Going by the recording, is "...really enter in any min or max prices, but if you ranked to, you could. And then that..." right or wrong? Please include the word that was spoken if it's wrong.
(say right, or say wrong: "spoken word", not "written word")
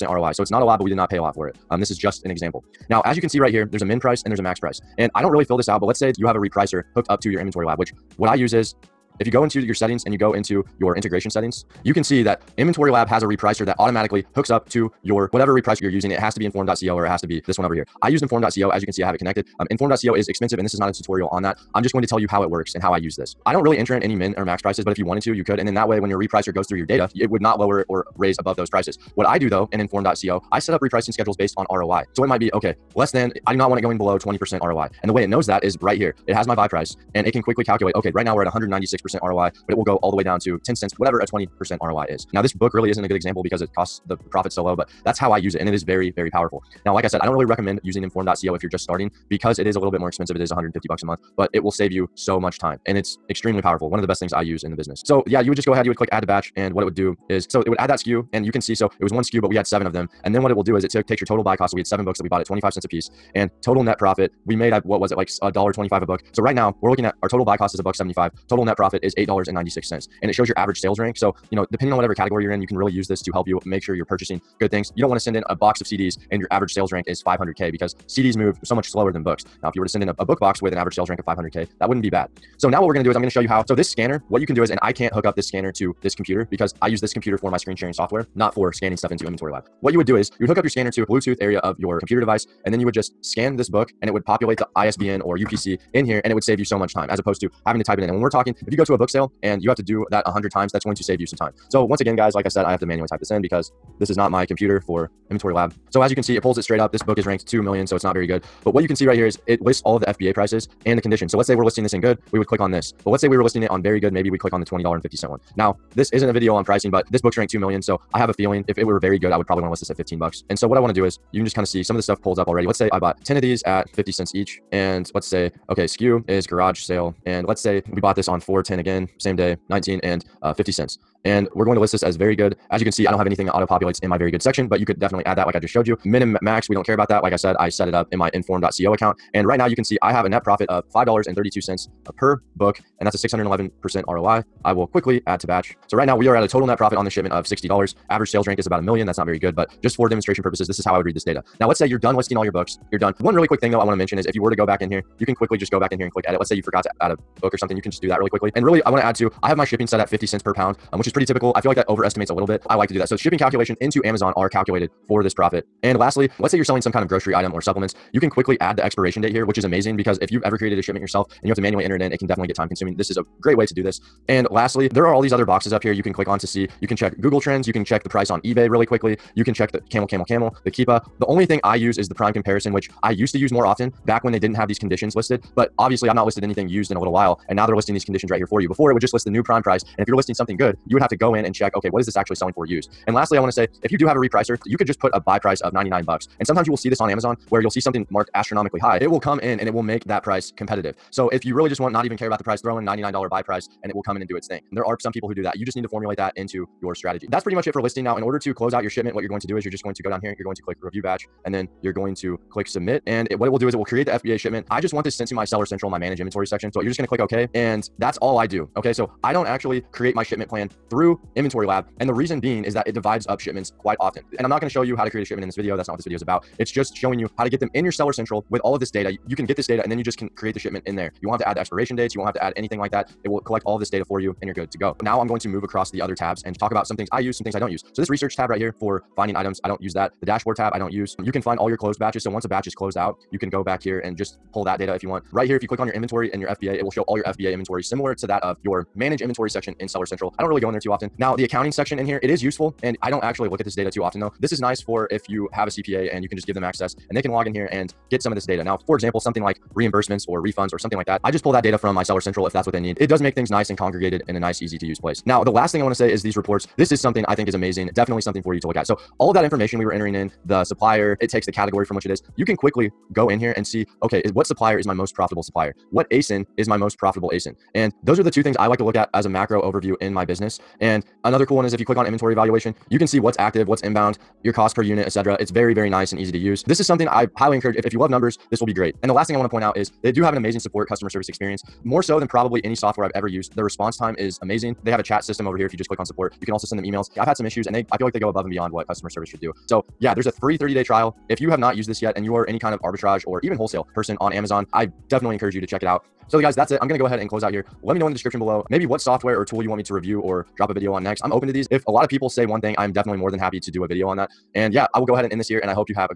wrong: "wanted", not "ranked".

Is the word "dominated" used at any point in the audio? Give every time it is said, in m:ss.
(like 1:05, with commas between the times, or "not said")
not said.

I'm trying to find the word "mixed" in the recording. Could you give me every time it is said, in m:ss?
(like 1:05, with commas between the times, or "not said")
not said.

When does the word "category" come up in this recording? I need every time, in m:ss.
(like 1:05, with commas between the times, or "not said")
1:12, 4:31.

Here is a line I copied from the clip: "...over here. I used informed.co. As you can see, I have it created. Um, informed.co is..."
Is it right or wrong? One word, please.
wrong.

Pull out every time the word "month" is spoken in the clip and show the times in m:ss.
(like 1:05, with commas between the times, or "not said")
0:51.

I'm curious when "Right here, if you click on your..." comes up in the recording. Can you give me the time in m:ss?
4:05.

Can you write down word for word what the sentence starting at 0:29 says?
What I do though in informed.co, I set up repricing schedules based on ROI.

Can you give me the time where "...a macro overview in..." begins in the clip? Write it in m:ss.
4:39.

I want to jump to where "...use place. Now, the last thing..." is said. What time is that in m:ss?
4:24.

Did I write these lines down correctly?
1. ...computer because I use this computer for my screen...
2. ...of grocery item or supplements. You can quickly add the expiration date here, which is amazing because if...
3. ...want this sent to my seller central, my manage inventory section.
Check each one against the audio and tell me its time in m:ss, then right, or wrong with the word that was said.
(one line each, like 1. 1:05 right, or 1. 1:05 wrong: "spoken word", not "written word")
1. 1:26 right
2. 2:47 right
3. 3:34 right.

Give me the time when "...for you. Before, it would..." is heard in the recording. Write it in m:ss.
3:08.